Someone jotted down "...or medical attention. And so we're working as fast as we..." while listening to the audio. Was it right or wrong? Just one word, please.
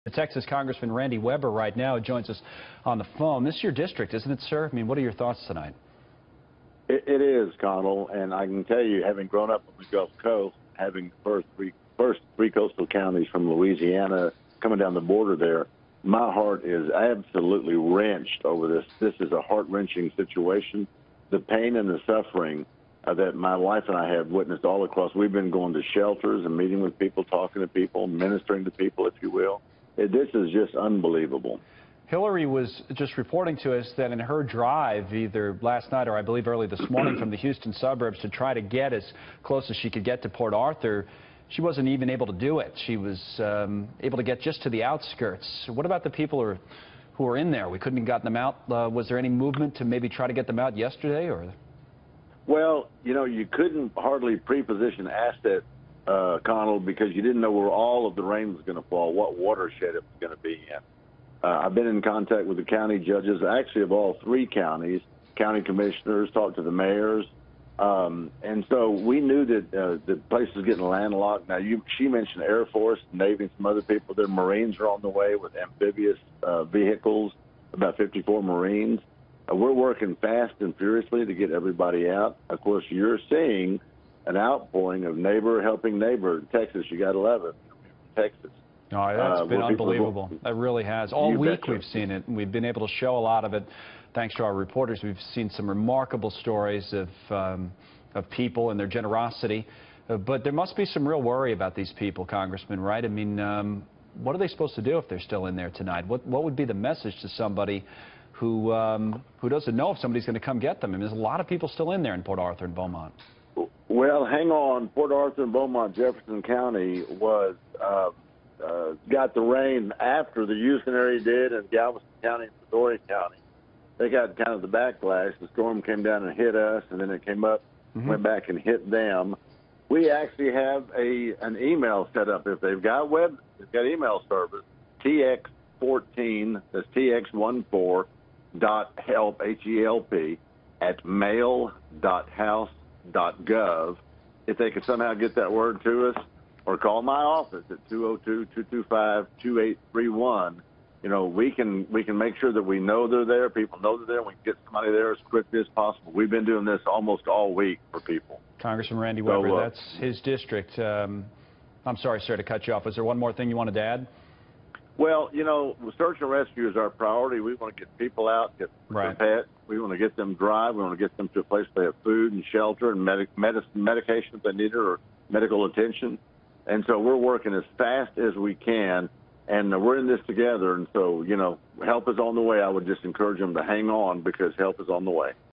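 right.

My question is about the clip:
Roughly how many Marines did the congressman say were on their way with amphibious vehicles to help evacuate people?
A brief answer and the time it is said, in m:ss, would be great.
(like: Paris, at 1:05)
54, at 1:17.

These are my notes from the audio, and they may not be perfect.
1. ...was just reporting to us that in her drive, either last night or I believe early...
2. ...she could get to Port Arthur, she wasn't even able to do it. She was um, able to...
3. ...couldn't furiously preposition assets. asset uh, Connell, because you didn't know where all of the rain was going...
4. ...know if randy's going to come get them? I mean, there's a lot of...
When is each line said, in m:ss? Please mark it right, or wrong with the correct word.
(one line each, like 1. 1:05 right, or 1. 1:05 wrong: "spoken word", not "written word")
1. 0:32 right
2. 0:39 right
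3. 0:53 wrong: "hardly", not "furiously"
4. 1:49 wrong: "somebody", not "randy".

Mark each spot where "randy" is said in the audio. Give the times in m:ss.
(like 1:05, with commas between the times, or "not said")
0:00, 2:38.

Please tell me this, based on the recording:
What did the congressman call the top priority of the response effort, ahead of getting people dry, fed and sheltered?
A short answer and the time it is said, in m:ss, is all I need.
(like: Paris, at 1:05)
search and rescue, at 2:45.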